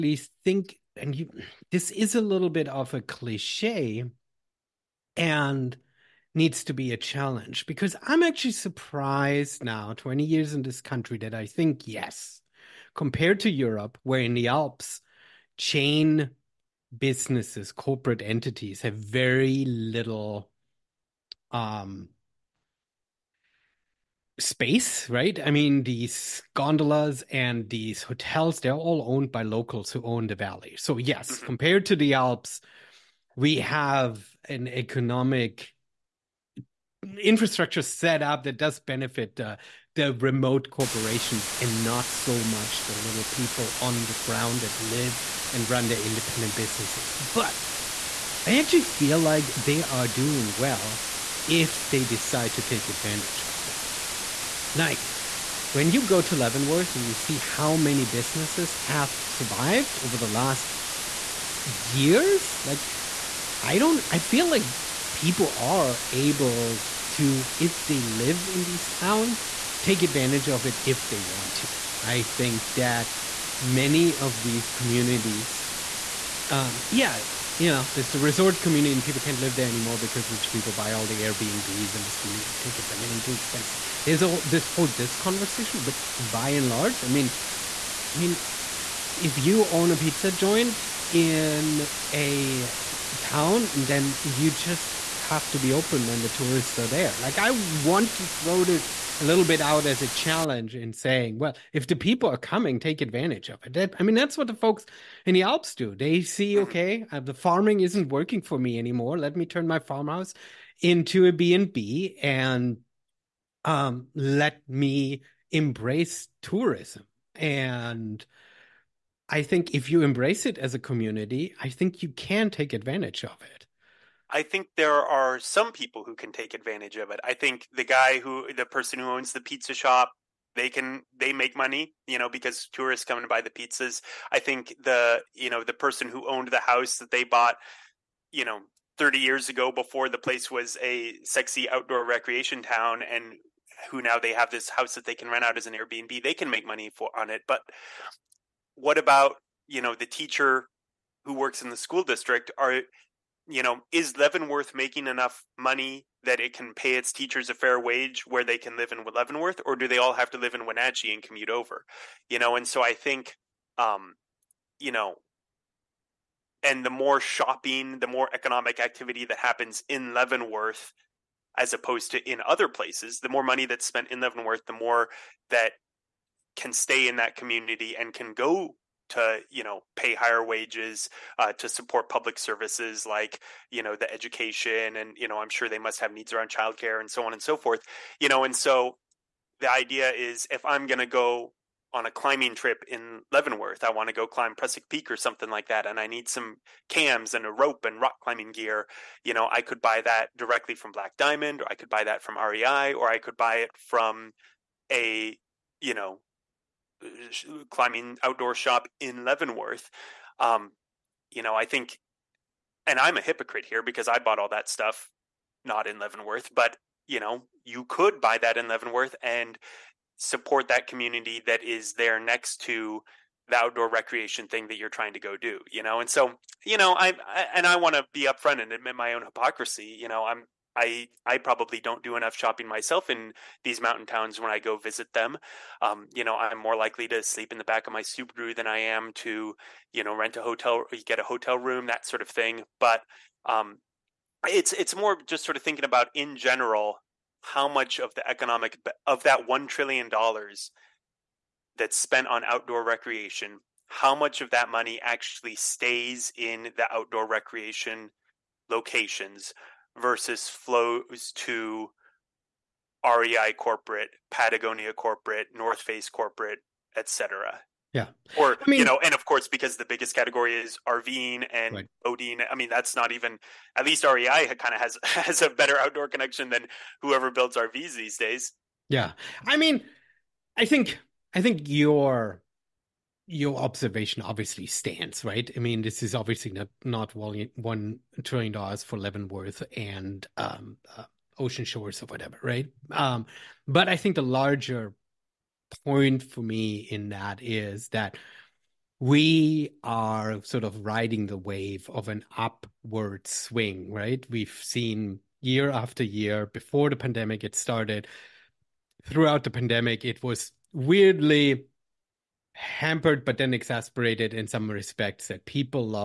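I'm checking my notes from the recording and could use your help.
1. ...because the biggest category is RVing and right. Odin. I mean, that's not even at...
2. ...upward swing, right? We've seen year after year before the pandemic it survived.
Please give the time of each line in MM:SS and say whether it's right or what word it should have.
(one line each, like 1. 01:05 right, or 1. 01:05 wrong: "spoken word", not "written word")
1. 04:29 right
2. 05:02 wrong: "started", not "survived".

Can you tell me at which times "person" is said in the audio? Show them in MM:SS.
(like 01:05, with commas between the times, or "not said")
02:08, 02:15.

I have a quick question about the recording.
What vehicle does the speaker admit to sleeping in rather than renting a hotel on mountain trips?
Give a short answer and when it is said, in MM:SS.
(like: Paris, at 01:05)
Subaru, at 03:58.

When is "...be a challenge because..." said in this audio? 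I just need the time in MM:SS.
00:06.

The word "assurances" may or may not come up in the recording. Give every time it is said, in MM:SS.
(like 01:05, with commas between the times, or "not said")
not said.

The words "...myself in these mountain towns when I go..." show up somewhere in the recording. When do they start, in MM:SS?
03:52.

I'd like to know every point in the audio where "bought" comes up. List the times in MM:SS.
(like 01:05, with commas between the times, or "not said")
02:17, 03:34.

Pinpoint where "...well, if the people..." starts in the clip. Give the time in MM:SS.
01:41.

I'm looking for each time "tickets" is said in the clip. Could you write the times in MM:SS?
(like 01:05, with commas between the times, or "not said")
01:22.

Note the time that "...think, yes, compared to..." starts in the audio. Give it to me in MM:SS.
00:11.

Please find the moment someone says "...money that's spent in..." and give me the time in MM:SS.
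02:53.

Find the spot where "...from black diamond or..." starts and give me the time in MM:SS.
03:20.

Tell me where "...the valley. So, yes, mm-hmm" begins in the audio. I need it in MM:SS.
00:30.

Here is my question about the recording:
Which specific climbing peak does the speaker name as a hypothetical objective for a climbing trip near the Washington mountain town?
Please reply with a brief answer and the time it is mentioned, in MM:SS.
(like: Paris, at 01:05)
Prusik Peak, at 03:14.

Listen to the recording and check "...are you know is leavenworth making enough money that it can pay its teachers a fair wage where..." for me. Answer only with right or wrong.
right.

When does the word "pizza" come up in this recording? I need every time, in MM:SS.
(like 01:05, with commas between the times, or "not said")
01:29, 02:09, 02:13.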